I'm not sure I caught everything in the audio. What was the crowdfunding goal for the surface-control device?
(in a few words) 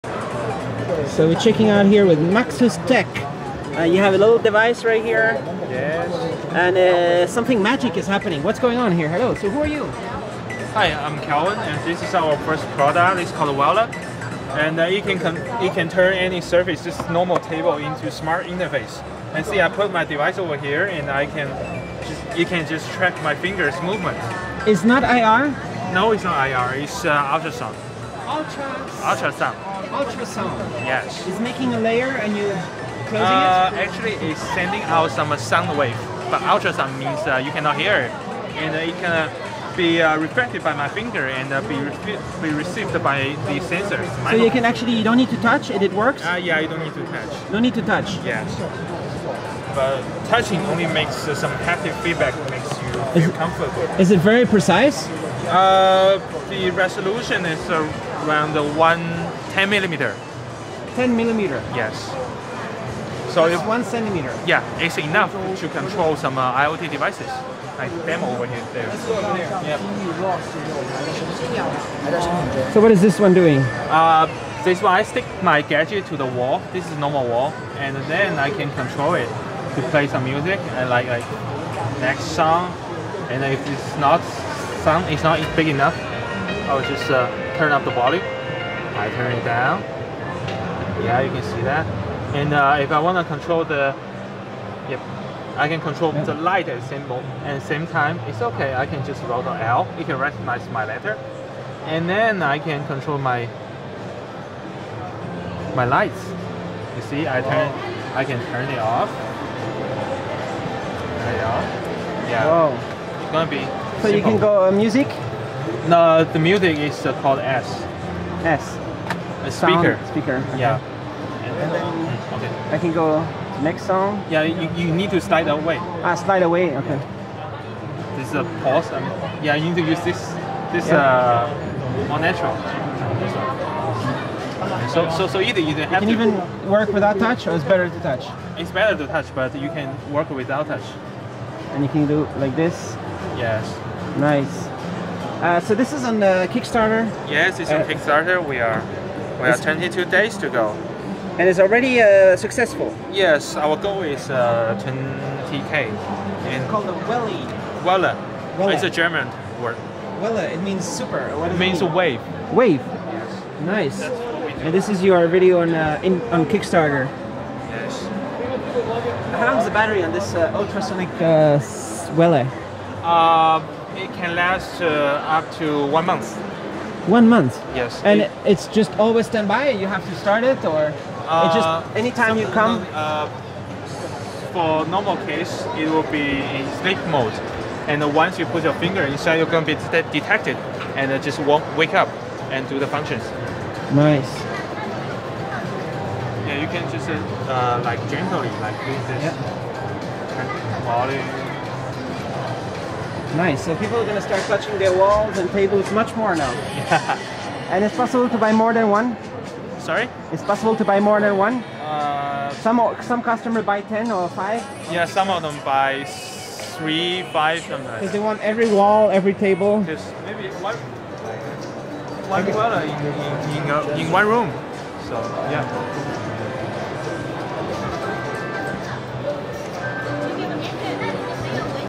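20k.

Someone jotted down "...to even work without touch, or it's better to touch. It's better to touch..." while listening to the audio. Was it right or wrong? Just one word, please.
right.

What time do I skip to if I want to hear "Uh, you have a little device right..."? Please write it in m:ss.
0:03.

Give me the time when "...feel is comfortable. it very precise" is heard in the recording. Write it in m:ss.
0:52.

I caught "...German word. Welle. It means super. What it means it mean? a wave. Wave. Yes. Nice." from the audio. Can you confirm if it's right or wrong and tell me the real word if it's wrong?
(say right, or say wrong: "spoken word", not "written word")
right.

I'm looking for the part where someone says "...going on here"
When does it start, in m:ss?
0:08.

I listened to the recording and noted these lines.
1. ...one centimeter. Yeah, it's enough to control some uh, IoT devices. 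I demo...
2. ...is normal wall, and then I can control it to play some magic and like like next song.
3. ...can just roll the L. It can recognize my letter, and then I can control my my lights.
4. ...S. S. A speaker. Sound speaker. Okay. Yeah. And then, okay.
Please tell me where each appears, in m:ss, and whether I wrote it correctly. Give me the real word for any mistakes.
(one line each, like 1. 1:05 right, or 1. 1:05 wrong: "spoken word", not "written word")
1. 1:03 right
2. 1:16 wrong: "music", not "magic"
3. 1:38 right
4. 1:57 right.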